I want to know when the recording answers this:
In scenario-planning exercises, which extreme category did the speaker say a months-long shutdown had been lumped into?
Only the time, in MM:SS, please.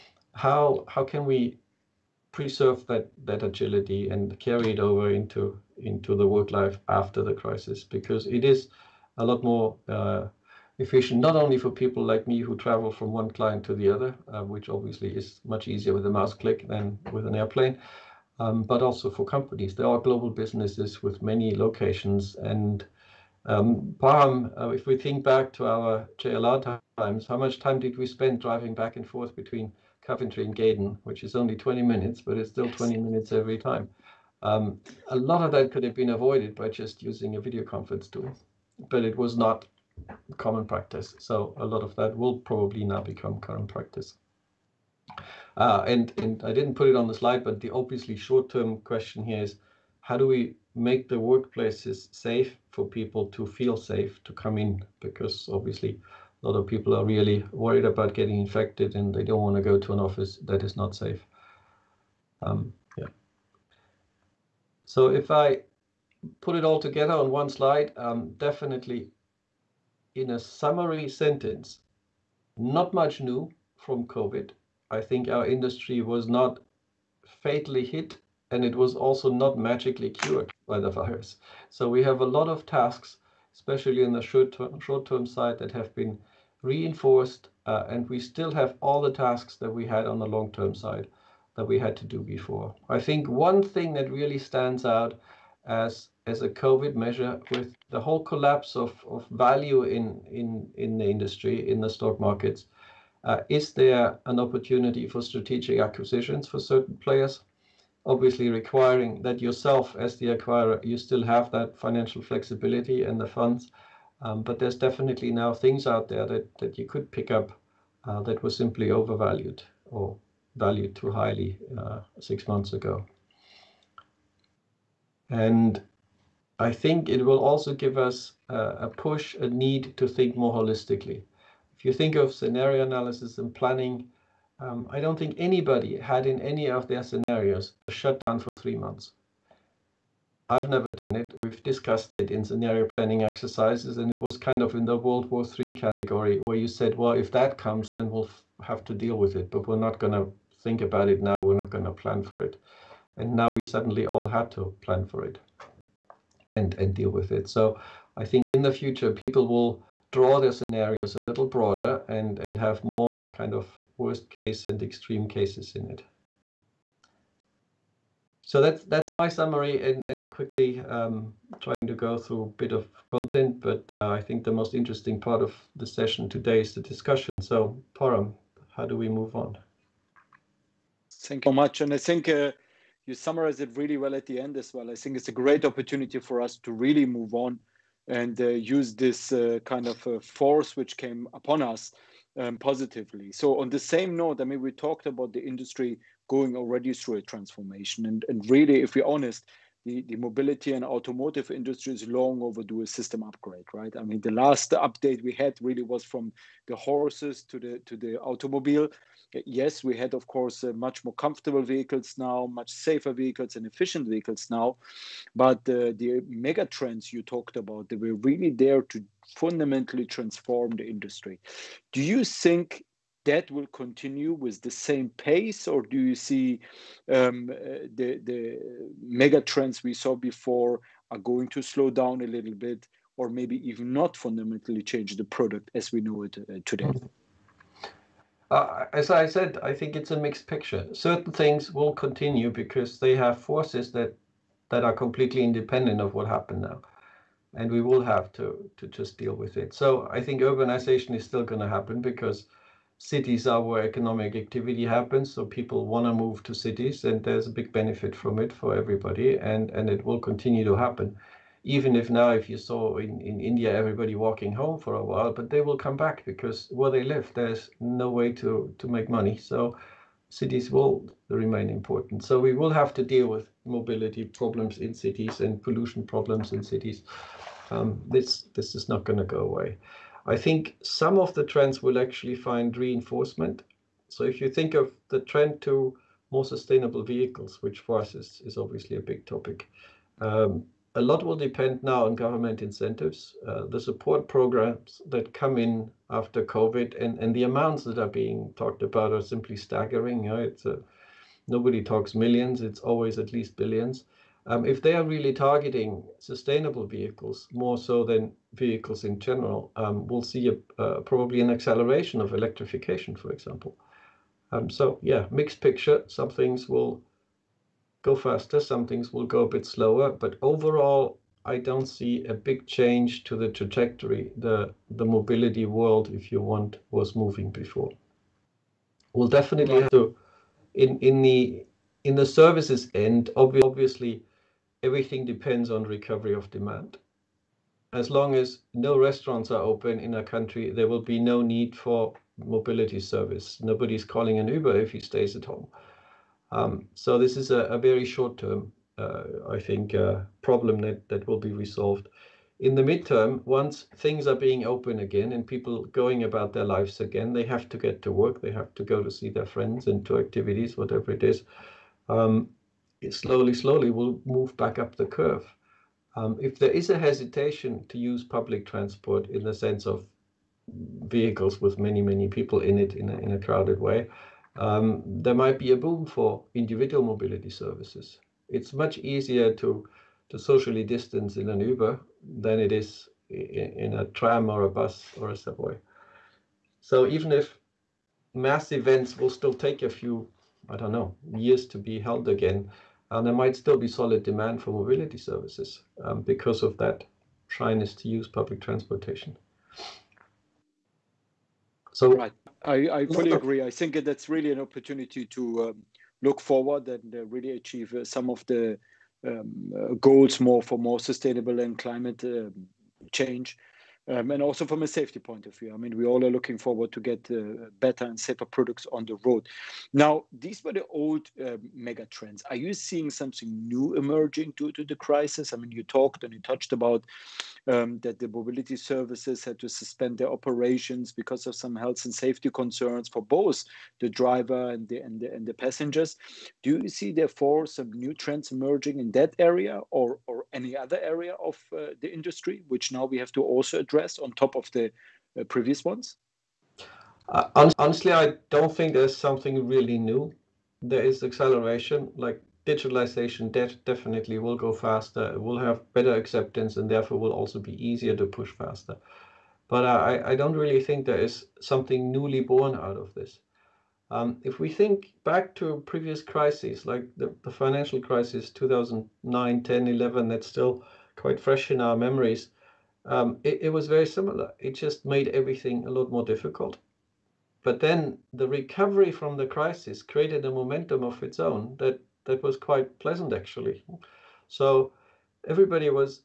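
02:24.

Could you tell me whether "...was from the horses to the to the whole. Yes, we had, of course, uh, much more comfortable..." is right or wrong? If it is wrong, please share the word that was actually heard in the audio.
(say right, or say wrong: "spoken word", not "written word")
wrong: "automobile", not "whole".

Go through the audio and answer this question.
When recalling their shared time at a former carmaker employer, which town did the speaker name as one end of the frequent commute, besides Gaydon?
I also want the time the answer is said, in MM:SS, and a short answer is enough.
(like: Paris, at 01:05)
Coventry, at 00:30.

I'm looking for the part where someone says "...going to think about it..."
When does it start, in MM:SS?
02:29.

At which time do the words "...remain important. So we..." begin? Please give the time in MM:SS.
04:31.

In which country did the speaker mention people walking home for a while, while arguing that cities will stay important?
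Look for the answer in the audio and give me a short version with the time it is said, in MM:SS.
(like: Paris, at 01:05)
India, at 04:23.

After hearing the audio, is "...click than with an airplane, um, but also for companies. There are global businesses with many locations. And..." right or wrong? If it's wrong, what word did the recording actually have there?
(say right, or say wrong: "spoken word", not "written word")
right.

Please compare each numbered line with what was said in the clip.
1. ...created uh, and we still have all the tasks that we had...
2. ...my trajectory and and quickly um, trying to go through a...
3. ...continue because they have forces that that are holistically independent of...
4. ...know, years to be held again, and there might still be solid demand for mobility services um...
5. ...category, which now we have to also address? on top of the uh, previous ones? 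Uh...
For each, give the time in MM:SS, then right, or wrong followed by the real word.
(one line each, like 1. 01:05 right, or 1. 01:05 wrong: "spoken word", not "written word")
1. 01:26 wrong: "reinforced", not "created"
2. 02:49 wrong: "summary", not "trajectory"
3. 04:01 wrong: "completely", not "holistically"
4. 06:30 right
5. 07:22 wrong: "industry", not "category".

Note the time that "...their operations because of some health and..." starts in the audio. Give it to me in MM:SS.
07:10.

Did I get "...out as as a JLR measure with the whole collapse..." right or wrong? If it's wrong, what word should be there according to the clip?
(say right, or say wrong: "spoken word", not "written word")
wrong: "COVID", not "JLR".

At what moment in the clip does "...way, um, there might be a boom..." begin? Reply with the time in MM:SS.
06:13.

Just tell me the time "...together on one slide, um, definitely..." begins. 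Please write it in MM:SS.
01:06.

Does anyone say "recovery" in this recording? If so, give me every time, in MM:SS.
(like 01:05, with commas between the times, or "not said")
05:35, 07:58.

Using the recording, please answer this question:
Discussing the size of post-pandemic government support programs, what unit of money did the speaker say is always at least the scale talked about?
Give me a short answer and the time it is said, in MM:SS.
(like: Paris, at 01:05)
billions, at 05:03.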